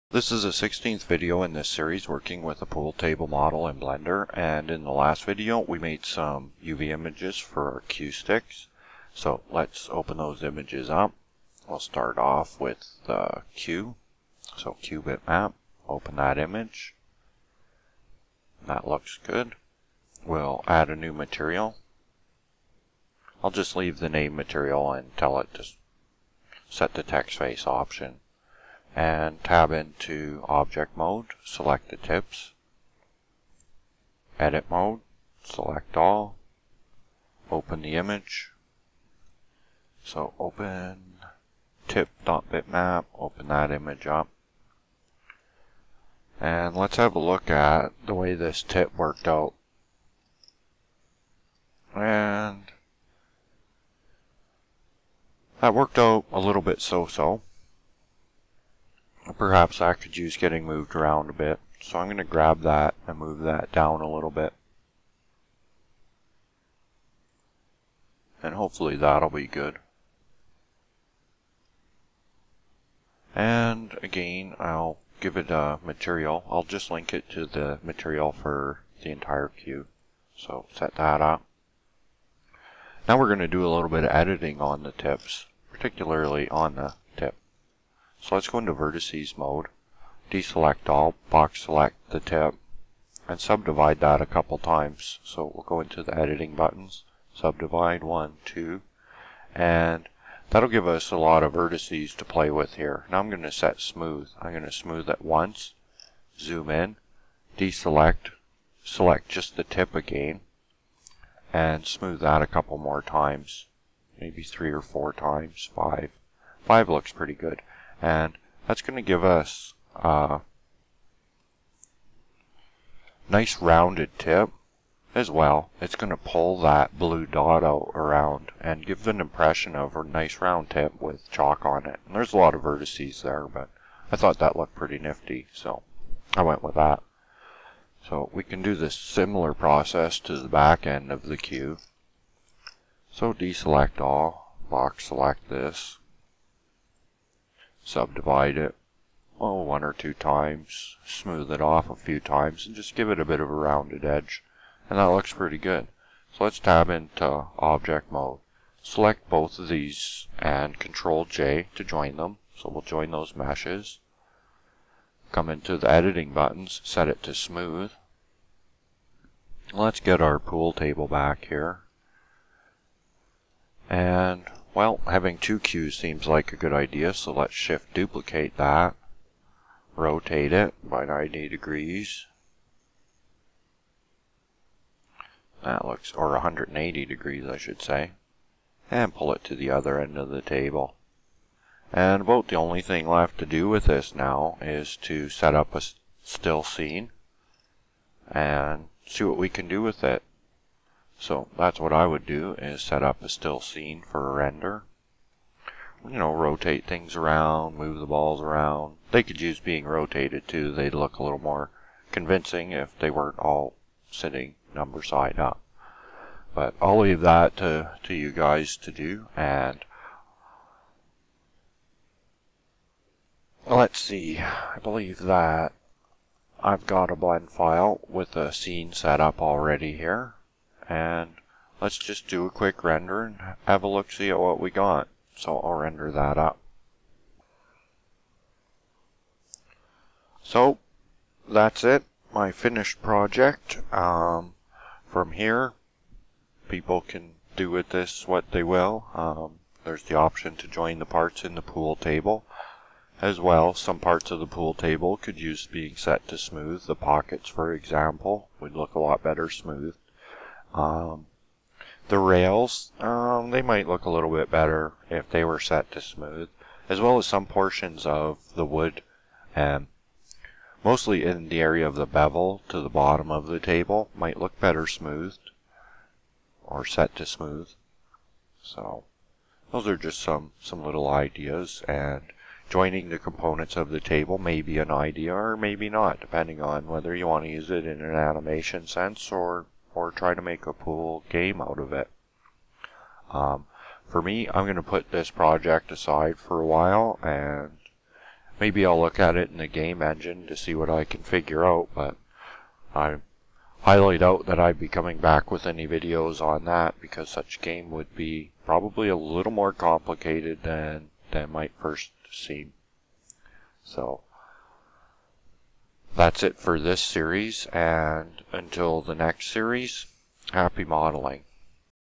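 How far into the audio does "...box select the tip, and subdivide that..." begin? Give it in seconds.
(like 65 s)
91 s.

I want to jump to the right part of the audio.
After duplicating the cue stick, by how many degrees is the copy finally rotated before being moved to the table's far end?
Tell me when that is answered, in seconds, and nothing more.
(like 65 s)
186 s.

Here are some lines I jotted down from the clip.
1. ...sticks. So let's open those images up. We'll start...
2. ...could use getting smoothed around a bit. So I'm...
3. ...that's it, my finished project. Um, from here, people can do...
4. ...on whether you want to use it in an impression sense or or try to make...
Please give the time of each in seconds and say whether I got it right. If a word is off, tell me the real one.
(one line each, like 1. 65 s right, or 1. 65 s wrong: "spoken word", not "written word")
1. 8 s right
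2. 59 s wrong: "moved", not "smoothed"
3. 241 s right
4. 286 s wrong: "animation", not "impression".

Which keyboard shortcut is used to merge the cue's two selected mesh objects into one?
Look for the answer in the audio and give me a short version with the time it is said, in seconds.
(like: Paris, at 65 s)
Control J, at 160 s.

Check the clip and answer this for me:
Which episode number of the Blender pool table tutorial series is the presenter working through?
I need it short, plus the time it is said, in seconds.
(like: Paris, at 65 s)
16th, at 0 s.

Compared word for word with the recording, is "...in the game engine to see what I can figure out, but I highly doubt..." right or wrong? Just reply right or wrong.
right.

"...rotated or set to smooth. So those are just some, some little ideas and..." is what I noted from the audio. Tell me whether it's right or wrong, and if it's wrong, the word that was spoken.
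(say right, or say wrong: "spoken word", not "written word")
wrong: "smoothed", not "rotated".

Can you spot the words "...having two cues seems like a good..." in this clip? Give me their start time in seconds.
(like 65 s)
175 s.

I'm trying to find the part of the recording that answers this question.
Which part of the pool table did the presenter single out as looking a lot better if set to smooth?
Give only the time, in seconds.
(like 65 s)
256 s.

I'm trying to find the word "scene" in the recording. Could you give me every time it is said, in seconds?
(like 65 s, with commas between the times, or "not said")
196 s, 203 s, 228 s.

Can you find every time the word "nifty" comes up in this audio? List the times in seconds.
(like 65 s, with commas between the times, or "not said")
134 s.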